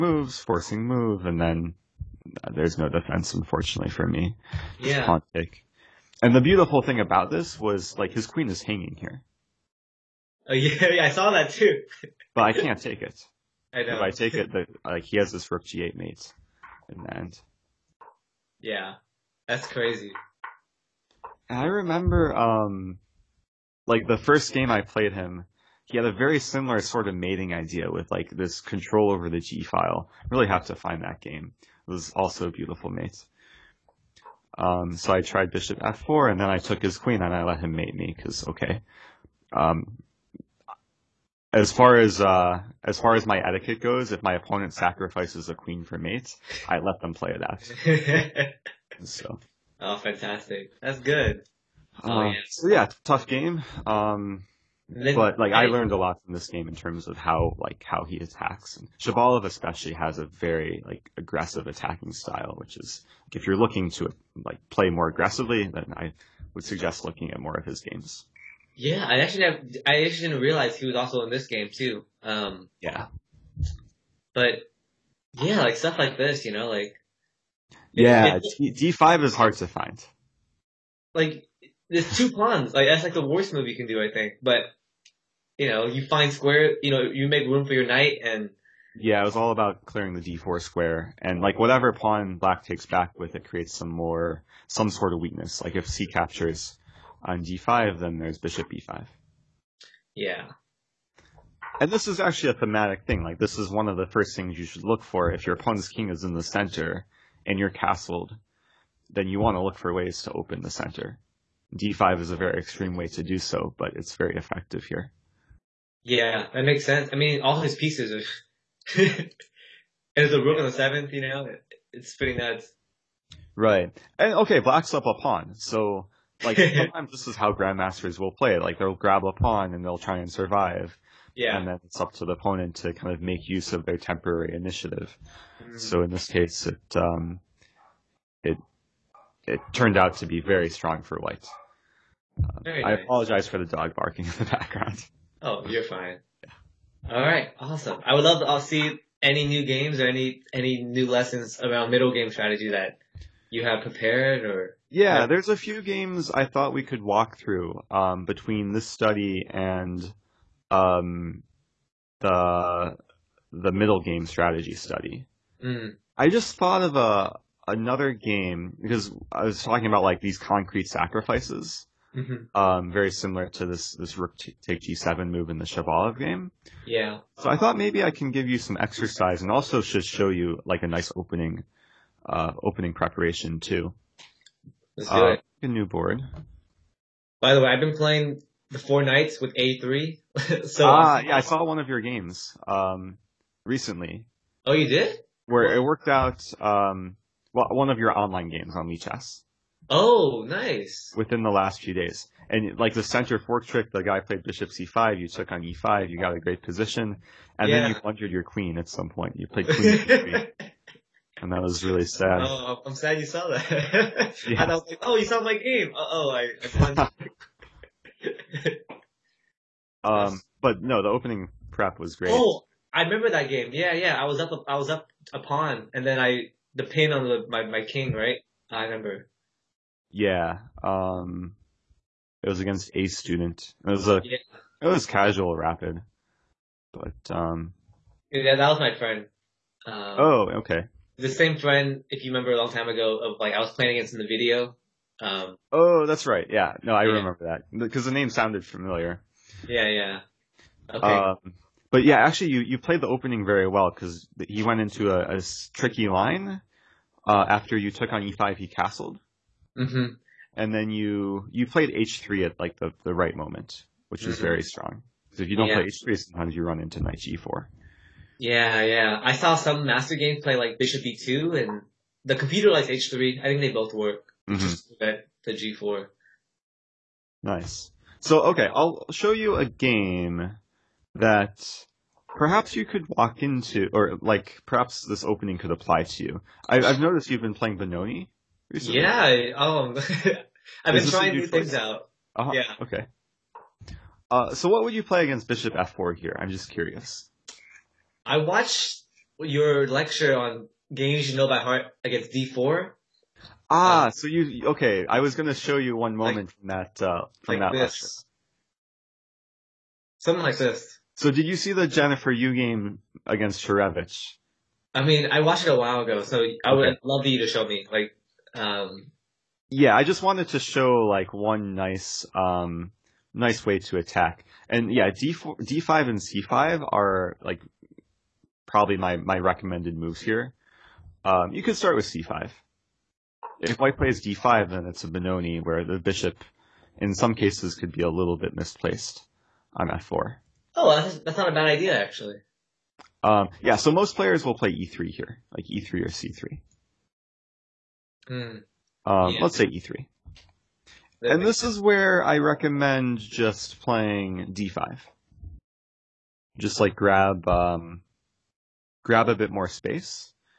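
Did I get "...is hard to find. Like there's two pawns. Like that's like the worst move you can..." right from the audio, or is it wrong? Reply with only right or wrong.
right.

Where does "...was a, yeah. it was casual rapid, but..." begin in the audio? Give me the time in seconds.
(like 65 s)
233 s.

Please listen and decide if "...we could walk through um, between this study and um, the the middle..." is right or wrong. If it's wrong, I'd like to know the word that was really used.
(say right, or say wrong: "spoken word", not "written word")
right.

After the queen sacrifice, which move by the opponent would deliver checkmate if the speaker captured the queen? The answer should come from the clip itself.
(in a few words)
Rook g8.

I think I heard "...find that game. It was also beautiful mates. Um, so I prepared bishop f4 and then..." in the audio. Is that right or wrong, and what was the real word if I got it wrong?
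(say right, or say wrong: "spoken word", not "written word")
wrong: "tried", not "prepared".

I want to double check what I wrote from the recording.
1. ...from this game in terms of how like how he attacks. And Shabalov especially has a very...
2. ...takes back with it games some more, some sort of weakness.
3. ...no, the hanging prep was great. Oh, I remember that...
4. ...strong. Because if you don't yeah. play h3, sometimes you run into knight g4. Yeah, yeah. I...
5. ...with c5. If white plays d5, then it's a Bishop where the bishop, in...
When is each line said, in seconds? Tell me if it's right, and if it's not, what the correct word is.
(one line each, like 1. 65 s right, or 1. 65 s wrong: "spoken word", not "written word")
1. 56 s right
2. 92 s wrong: "creates", not "games"
3. 220 s wrong: "opening", not "hanging"
4. 264 s right
5. 331 s wrong: "Benoni", not "Bishop".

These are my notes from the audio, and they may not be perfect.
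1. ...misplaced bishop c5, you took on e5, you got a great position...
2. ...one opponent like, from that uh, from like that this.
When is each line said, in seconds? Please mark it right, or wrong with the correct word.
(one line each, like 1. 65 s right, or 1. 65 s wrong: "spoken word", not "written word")
1. 204 s wrong: "played", not "misplaced"
2. 305 s wrong: "moment", not "opponent".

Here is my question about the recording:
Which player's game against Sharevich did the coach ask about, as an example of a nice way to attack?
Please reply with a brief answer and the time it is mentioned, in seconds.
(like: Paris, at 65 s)
Jennifer Yu, at 311 s.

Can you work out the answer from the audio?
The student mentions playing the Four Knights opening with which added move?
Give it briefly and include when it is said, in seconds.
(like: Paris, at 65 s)
a3, at 189 s.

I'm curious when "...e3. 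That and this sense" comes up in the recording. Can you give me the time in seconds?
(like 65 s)
349 s.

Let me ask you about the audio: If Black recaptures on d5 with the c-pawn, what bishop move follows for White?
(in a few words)
Bishop e5.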